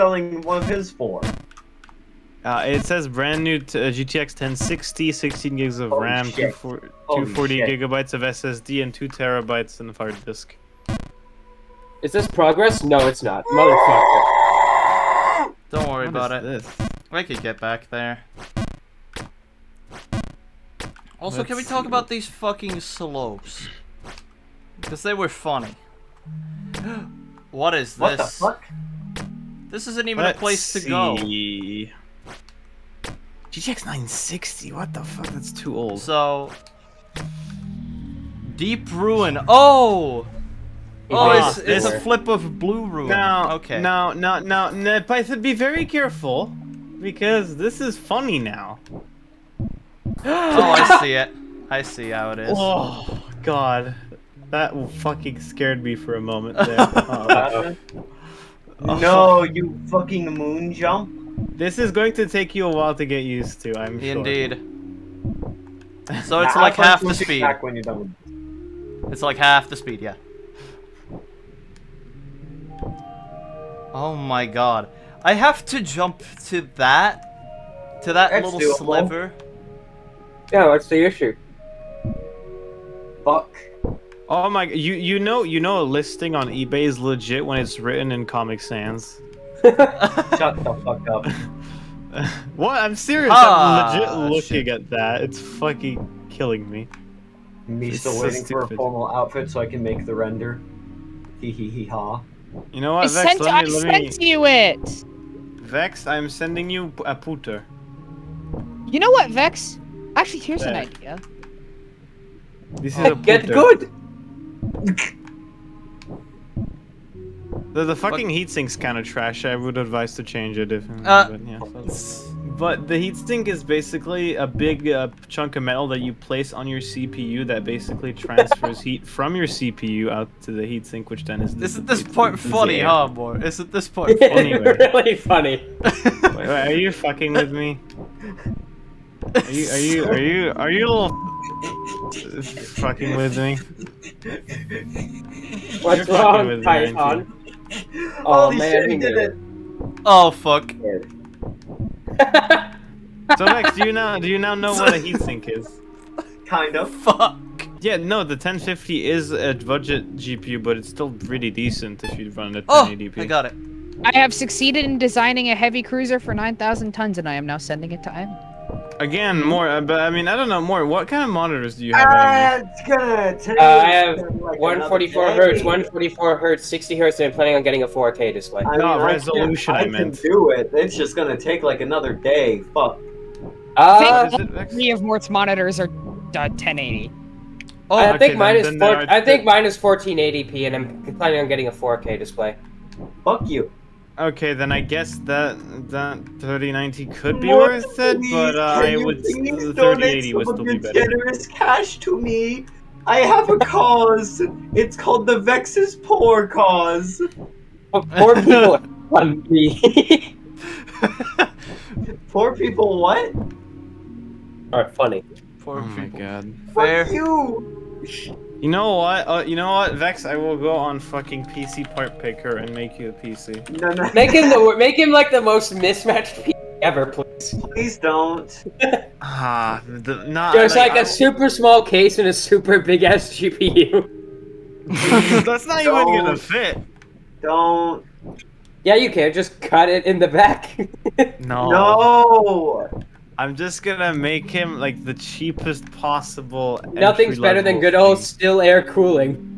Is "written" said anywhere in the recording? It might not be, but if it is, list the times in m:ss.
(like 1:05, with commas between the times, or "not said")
1:27.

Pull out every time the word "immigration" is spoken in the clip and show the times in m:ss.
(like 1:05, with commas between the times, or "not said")
not said.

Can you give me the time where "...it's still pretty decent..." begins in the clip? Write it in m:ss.
2:40.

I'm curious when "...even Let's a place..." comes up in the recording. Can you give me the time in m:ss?
0:30.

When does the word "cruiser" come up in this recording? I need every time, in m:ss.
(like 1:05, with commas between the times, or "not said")
2:45.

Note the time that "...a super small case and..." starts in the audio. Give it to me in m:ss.
3:51.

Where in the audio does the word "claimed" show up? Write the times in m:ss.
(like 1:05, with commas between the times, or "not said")
not said.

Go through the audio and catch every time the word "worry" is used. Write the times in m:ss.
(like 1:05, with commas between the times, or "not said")
0:15.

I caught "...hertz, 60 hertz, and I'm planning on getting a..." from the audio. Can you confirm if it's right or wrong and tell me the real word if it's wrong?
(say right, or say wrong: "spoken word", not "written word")
right.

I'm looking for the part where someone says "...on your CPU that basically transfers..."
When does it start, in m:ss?
2:06.